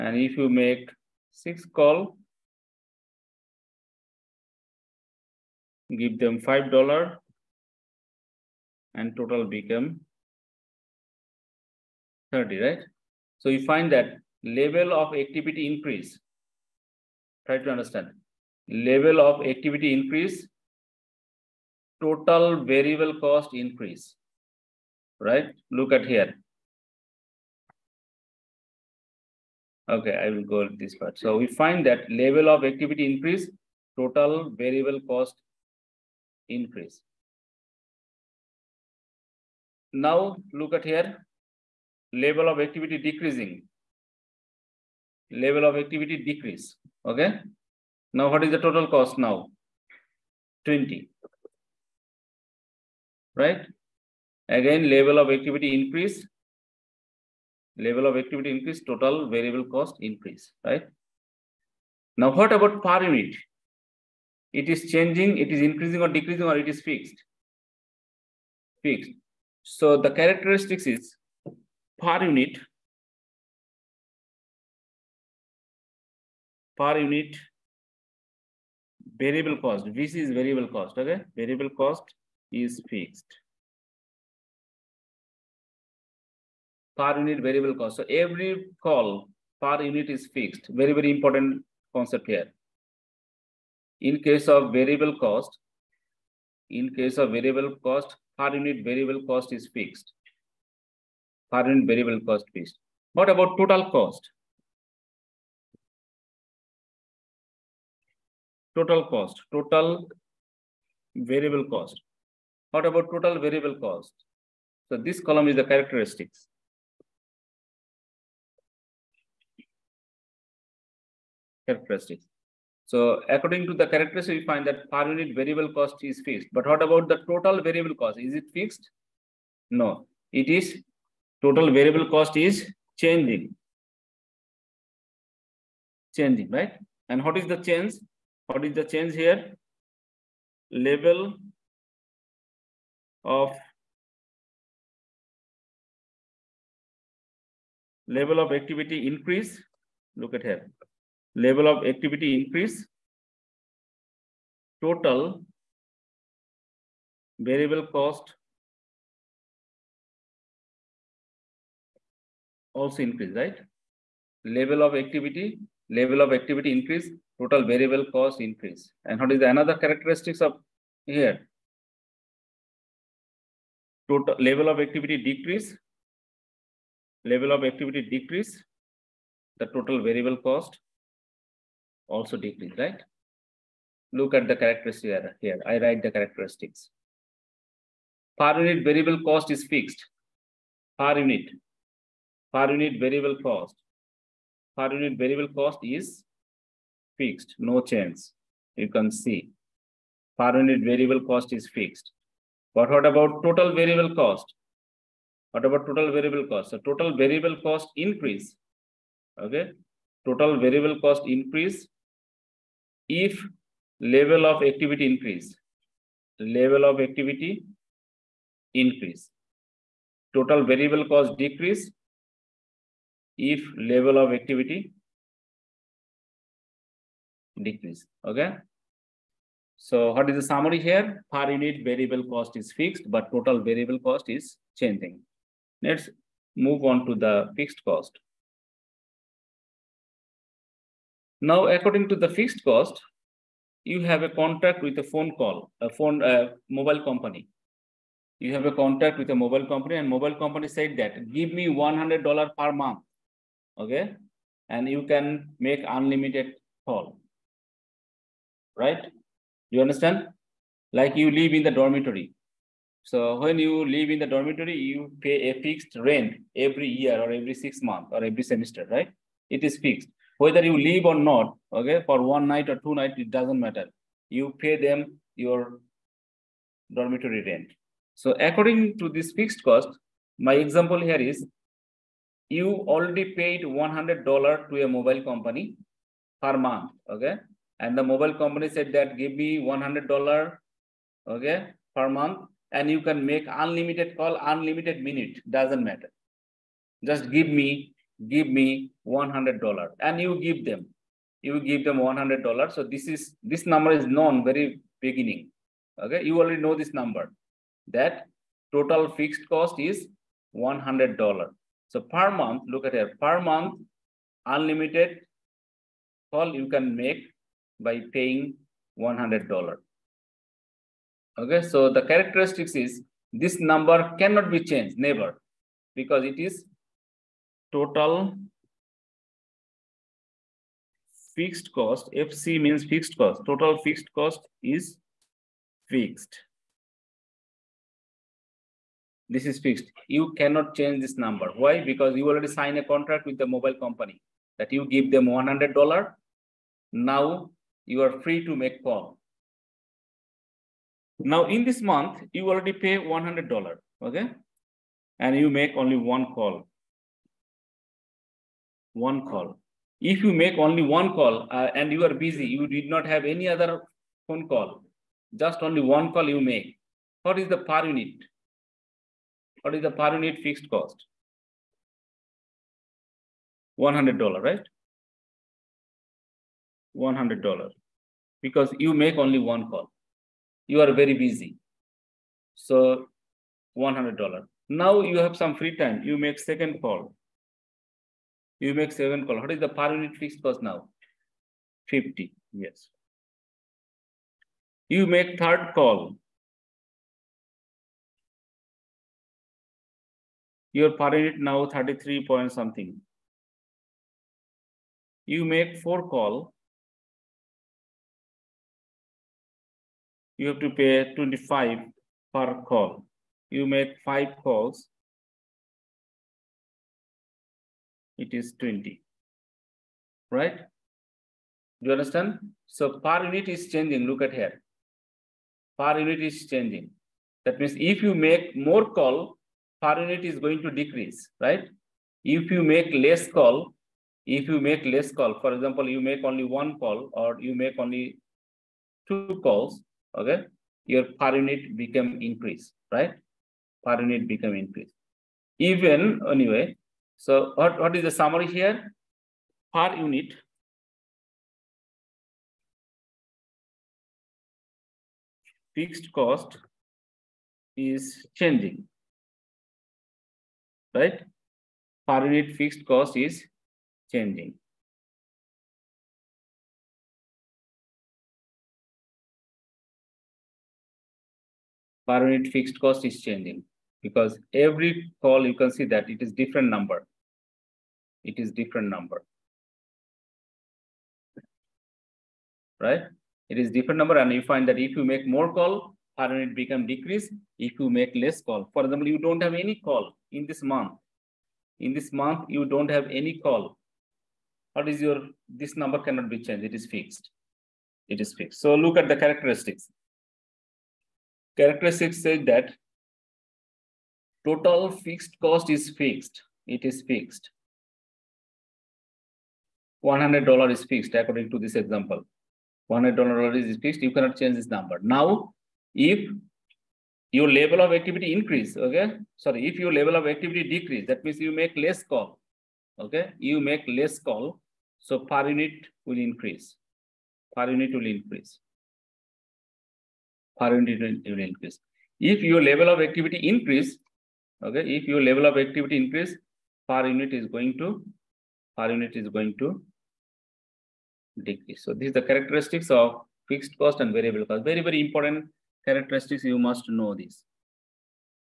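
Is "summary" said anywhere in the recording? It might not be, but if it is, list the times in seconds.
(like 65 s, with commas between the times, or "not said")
230 s, 448 s.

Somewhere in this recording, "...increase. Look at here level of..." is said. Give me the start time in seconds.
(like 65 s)
149 s.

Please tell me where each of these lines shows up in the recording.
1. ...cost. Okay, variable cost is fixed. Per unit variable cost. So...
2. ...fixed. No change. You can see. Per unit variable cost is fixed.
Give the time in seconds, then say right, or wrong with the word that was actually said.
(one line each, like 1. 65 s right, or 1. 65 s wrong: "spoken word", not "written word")
1. 80 s right
2. 197 s right.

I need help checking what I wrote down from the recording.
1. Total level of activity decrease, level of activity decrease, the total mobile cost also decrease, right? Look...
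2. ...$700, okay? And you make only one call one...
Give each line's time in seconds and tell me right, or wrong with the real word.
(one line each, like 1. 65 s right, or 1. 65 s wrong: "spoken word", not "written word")
1. 174 s wrong: "variable", not "mobile"
2. 352 s wrong: "100", not "700".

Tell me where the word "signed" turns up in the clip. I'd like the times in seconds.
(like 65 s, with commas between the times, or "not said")
342 s.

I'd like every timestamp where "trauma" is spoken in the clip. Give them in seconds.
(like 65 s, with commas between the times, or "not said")
not said.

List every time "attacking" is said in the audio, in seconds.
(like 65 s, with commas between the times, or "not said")
not said.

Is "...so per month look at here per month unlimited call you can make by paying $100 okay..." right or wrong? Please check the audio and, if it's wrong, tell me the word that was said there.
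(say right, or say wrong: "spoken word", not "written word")
right.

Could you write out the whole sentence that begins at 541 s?
So these are the characteristics of fixed cost and variable cost.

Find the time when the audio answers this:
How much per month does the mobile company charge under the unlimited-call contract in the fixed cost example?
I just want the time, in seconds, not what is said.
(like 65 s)
251 s.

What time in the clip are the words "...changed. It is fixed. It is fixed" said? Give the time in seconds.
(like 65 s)
496 s.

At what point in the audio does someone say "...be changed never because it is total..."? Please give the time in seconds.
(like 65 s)
324 s.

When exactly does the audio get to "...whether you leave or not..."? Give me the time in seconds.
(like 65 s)
270 s.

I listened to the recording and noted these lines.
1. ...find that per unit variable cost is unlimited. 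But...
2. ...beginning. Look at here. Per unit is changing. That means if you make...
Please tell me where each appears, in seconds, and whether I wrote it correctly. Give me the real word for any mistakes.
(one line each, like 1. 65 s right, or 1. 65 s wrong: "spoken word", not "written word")
1. 124 s wrong: "fixed", not "unlimited"
2. 423 s wrong: "changing", not "beginning".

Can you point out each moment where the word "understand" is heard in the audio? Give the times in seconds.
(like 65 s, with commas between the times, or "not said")
17 s, 259 s, 421 s.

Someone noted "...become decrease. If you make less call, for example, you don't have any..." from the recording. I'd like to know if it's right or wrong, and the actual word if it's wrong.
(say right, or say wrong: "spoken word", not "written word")
right.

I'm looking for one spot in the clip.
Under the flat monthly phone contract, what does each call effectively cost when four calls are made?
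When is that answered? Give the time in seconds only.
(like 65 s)
411 s.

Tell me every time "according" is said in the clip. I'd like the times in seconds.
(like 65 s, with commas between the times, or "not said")
123 s, 241 s, 278 s, 511 s.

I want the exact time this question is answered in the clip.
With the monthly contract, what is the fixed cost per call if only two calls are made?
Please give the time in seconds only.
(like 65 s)
391 s.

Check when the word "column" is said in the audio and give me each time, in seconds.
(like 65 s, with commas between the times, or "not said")
115 s, 389 s.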